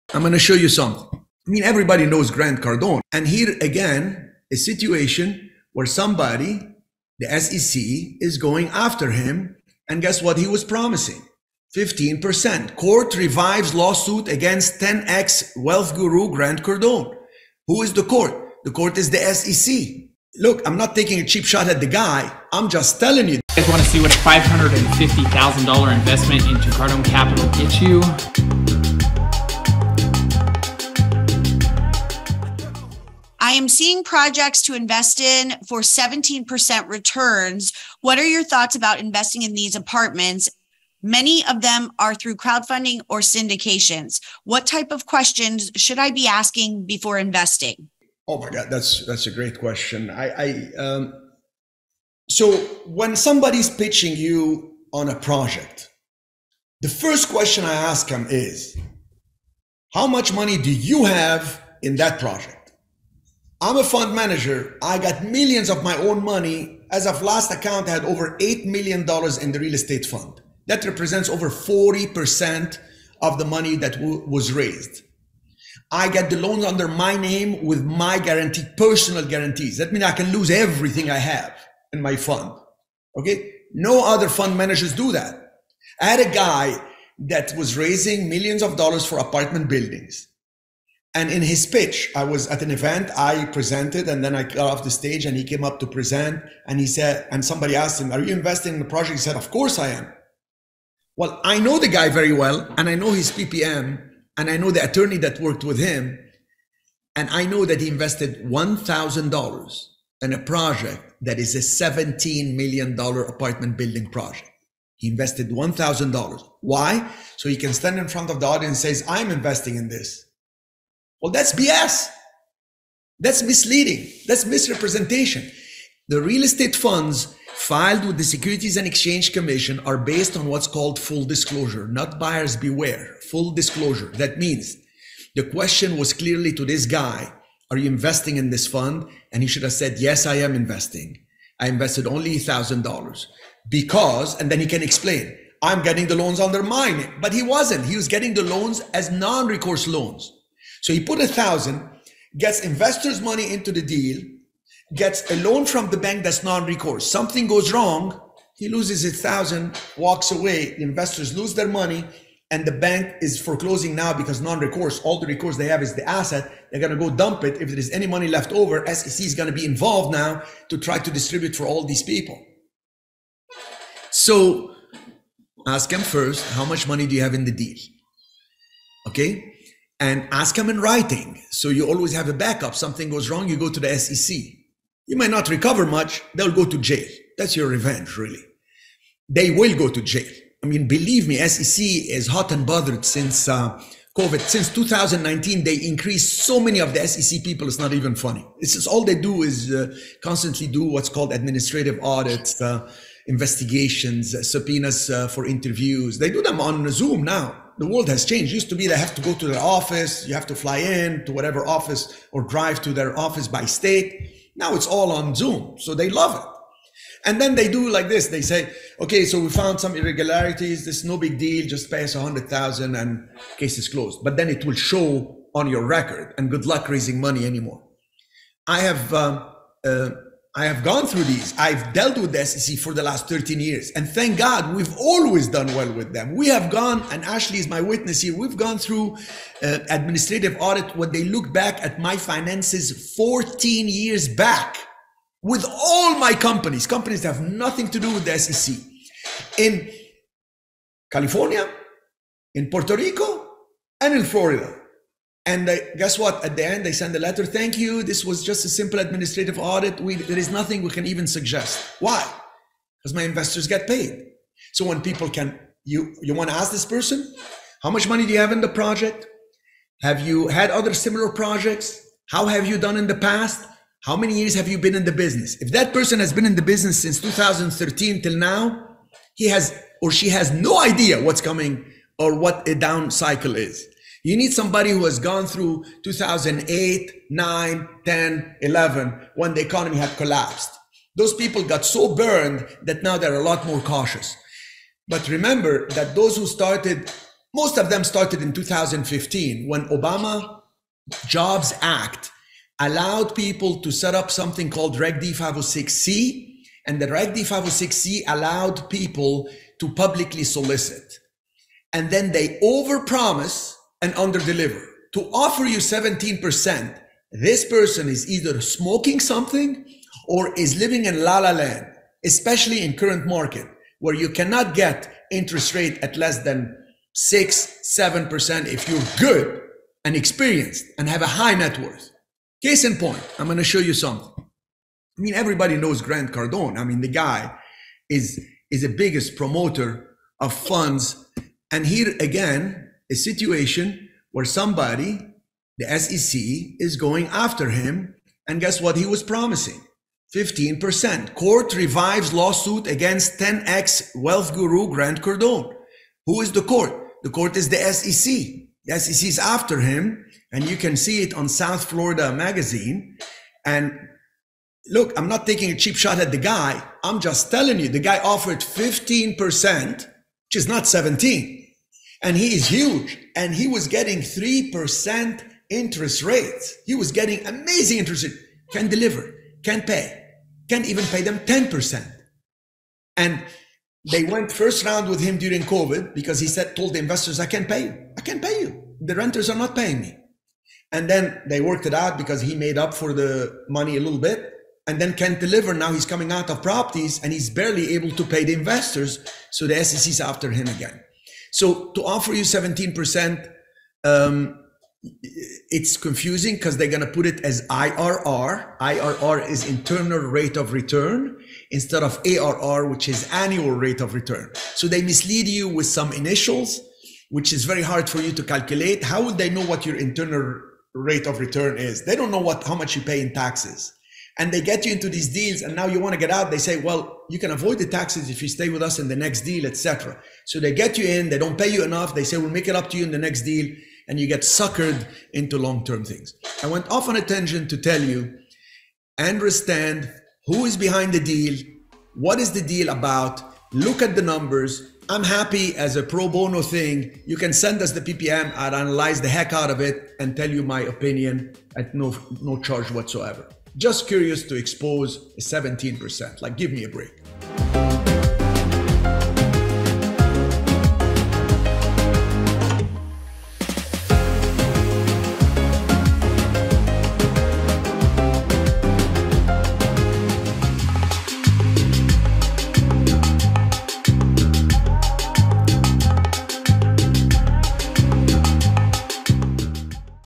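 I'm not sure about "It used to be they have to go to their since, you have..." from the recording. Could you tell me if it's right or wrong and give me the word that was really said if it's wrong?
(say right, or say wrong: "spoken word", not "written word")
wrong: "office", not "since".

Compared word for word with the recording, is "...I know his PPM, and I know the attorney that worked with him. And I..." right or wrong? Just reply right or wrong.
right.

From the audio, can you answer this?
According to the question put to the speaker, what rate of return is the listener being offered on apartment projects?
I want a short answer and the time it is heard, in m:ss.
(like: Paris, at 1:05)
17%, at 0:35.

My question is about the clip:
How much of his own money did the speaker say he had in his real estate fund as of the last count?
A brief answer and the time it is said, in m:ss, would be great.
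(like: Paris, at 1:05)
$8 million, at 1:08.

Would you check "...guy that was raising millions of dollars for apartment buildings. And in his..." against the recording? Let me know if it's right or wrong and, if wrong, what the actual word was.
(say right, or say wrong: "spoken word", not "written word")
right.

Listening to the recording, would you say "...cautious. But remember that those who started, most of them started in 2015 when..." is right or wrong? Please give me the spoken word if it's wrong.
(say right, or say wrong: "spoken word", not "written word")
right.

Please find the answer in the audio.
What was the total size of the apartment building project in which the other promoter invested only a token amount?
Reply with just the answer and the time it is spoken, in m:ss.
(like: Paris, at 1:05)
$17 million, at 1:51.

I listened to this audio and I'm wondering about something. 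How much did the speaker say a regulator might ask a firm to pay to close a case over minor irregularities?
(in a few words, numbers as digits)
$100,000.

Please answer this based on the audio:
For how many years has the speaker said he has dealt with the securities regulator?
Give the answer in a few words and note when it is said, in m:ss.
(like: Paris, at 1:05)
13 years, at 3:53.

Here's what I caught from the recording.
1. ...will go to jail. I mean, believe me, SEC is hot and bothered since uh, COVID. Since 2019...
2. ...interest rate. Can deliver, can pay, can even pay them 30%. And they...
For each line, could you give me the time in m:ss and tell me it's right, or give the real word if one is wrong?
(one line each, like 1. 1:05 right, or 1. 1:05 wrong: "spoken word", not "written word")
1. 3:09 right
2. 6:17 wrong: "10", not "30".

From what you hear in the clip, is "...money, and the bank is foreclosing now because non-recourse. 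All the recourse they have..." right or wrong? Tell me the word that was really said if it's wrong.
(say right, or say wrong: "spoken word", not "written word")
right.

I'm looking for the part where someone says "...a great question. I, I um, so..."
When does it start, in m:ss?
0:49.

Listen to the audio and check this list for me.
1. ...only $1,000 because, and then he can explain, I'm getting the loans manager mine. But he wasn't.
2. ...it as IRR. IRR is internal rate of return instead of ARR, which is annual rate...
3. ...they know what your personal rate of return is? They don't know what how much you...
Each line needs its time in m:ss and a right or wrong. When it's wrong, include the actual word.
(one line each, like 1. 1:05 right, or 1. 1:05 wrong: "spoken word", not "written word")
1. 2:22 wrong: "under", not "manager"
2. 6:47 right
3. 6:59 wrong: "internal", not "personal".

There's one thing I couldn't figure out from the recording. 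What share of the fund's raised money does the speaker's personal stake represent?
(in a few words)
Over 40%.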